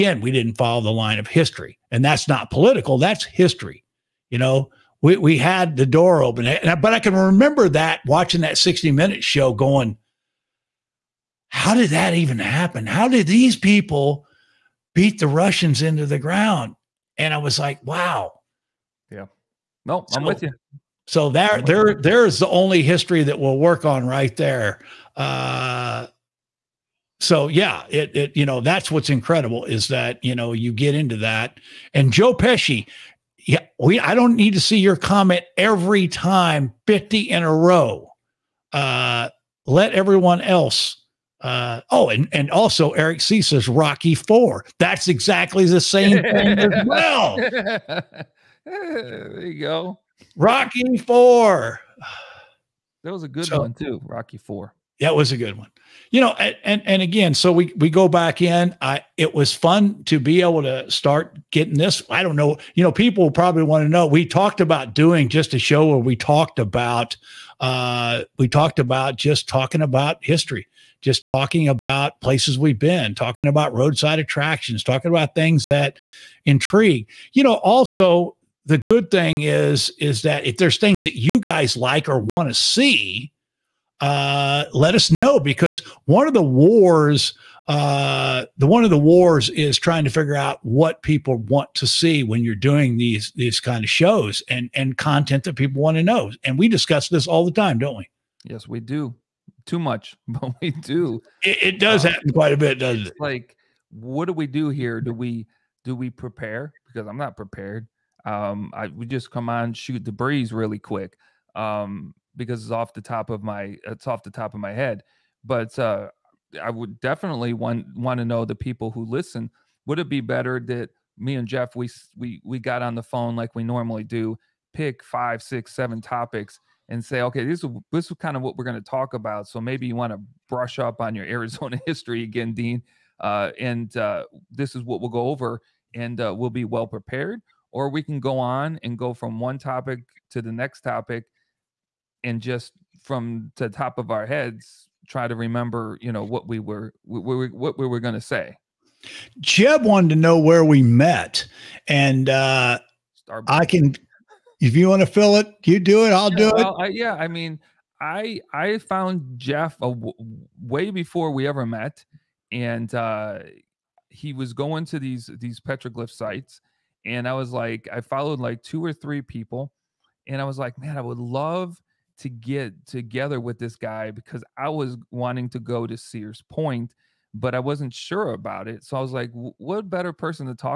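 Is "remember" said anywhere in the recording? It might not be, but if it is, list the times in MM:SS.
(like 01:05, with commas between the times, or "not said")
00:07, 02:25.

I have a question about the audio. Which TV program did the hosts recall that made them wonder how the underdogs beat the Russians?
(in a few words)
60 minute show.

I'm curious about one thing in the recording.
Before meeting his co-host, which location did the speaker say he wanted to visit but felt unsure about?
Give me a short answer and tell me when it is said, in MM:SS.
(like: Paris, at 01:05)
Sears Point, at 02:55.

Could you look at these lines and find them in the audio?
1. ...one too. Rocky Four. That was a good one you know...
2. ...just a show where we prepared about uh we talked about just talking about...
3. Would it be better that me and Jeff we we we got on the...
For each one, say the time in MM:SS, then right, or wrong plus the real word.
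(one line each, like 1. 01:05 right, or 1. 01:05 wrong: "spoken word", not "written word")
1. 00:53 right
2. 01:05 wrong: "talked", not "prepared"
3. 01:59 right.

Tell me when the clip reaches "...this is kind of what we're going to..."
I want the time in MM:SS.
02:07.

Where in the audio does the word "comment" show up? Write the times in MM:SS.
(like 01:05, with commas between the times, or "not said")
00:34.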